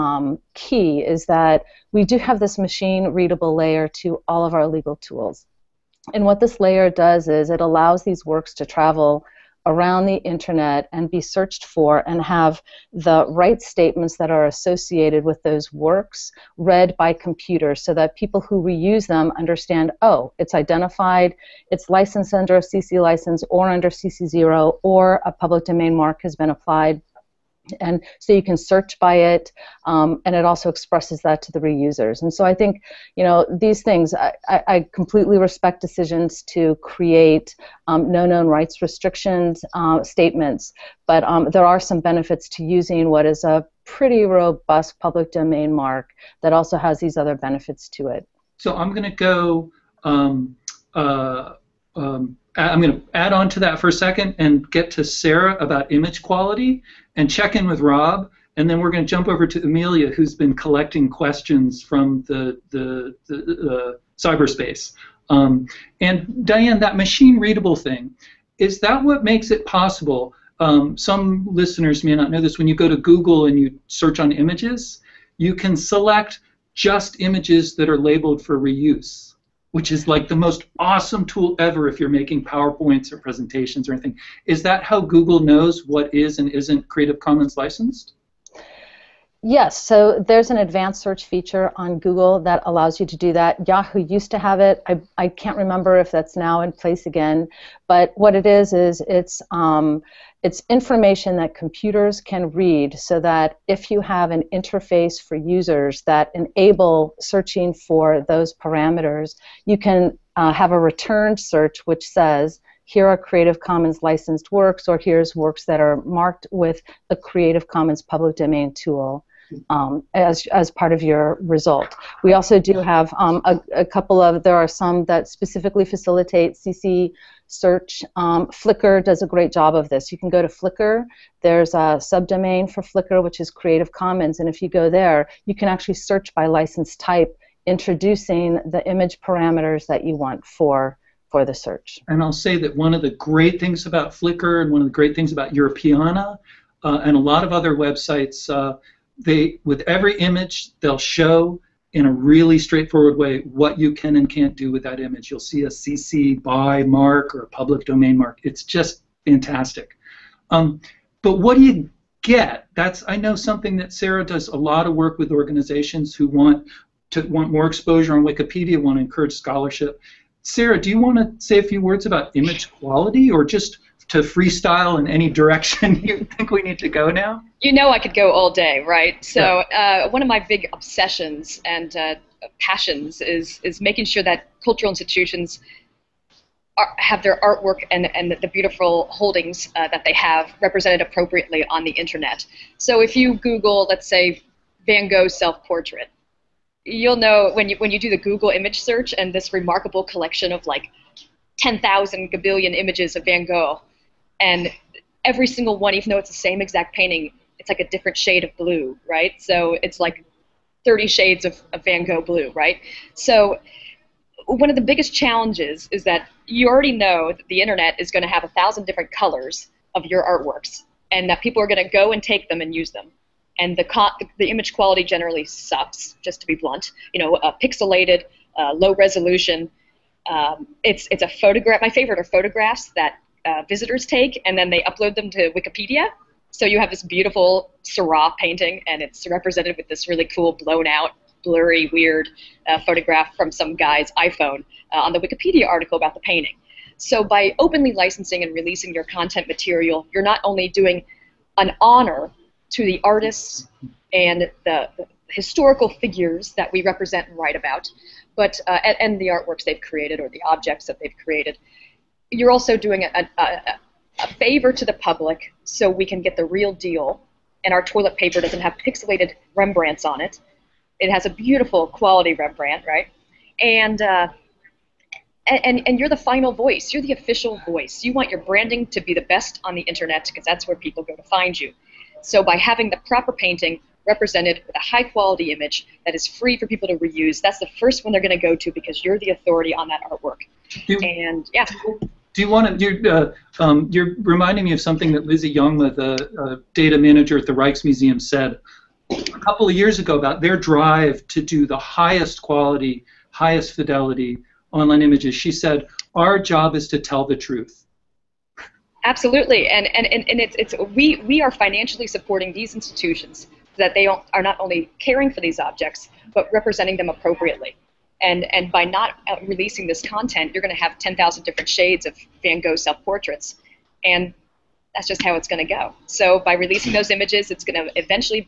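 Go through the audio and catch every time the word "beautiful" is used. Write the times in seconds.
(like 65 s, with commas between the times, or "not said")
188 s, 237 s, 271 s.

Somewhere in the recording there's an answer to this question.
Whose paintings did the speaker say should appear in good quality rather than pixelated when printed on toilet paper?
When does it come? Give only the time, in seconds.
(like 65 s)
268 s.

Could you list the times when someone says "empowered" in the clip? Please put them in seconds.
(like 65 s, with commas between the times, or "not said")
not said.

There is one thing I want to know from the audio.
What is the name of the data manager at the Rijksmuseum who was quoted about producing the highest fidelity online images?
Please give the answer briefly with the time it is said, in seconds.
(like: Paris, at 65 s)
Lizzie Jongma, at 295 s.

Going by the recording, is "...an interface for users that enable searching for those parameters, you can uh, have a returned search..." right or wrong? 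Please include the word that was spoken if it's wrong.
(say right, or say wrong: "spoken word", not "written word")
right.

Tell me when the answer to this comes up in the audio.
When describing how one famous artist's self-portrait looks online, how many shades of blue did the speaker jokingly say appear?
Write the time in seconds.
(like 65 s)
210 s.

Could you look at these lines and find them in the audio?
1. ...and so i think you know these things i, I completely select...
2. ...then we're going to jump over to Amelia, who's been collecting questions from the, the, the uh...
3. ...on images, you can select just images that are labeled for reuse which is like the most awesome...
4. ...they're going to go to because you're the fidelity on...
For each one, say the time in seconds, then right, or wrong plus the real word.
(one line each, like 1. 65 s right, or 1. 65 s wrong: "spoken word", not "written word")
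1. 32 s wrong: "respect", not "select"
2. 58 s right
3. 74 s right
4. 288 s wrong: "authority", not "fidelity".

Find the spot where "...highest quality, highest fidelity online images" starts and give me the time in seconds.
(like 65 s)
301 s.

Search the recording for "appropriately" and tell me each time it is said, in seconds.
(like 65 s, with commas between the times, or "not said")
191 s, 317 s.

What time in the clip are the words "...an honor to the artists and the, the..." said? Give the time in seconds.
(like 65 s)
251 s.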